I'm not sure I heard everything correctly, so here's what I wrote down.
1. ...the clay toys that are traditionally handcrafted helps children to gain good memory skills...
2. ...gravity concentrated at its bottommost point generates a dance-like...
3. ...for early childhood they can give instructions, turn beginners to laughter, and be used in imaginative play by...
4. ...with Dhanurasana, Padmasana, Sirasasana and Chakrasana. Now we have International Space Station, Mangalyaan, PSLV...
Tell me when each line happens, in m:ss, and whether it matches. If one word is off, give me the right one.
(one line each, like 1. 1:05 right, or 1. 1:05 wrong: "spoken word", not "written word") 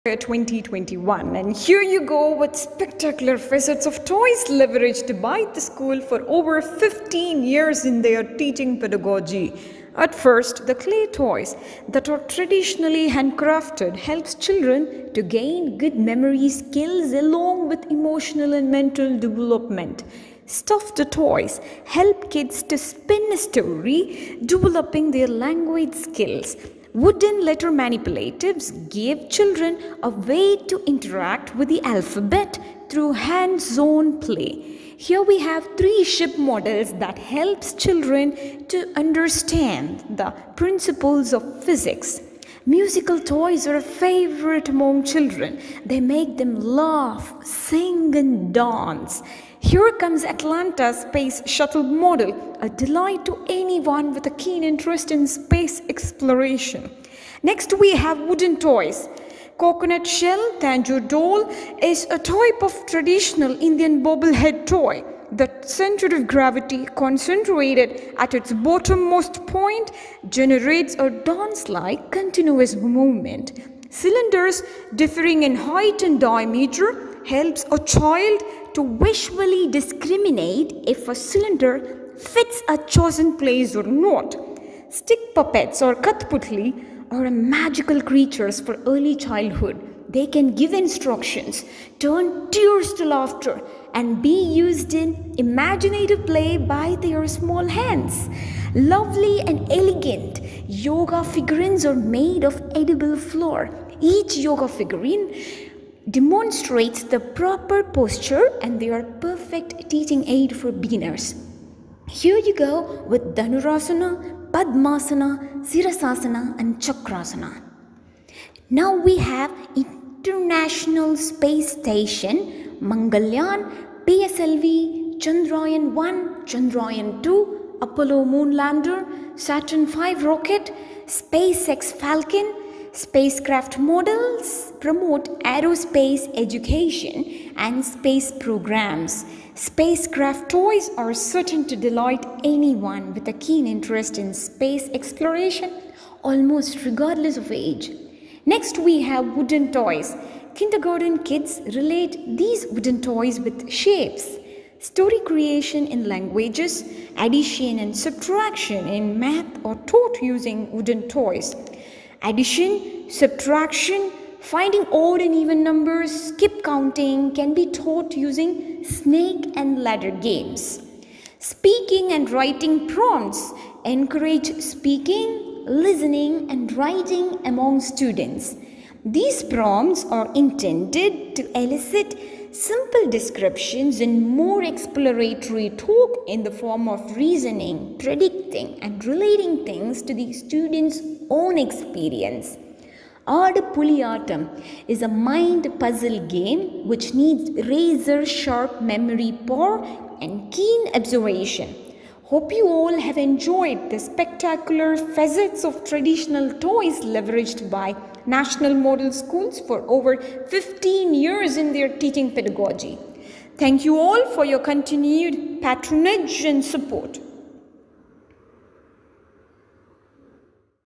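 1. 0:10 right
2. 1:06 right
3. 1:28 wrong: "tears", not "beginners"
4. 1:53 right.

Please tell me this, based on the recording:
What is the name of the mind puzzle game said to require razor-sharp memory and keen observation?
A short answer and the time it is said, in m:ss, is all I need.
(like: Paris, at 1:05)
Aadu Puliyatam, at 3:13.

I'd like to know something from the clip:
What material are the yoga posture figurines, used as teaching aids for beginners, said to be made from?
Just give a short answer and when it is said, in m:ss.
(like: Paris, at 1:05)
Edible flour, at 1:42.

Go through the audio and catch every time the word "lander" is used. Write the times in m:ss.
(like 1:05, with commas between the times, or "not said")
2:08.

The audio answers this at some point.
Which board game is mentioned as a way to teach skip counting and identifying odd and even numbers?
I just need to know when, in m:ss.
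2:48.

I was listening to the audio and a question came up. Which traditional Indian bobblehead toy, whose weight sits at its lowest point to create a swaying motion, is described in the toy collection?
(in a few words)
Tanjore doll.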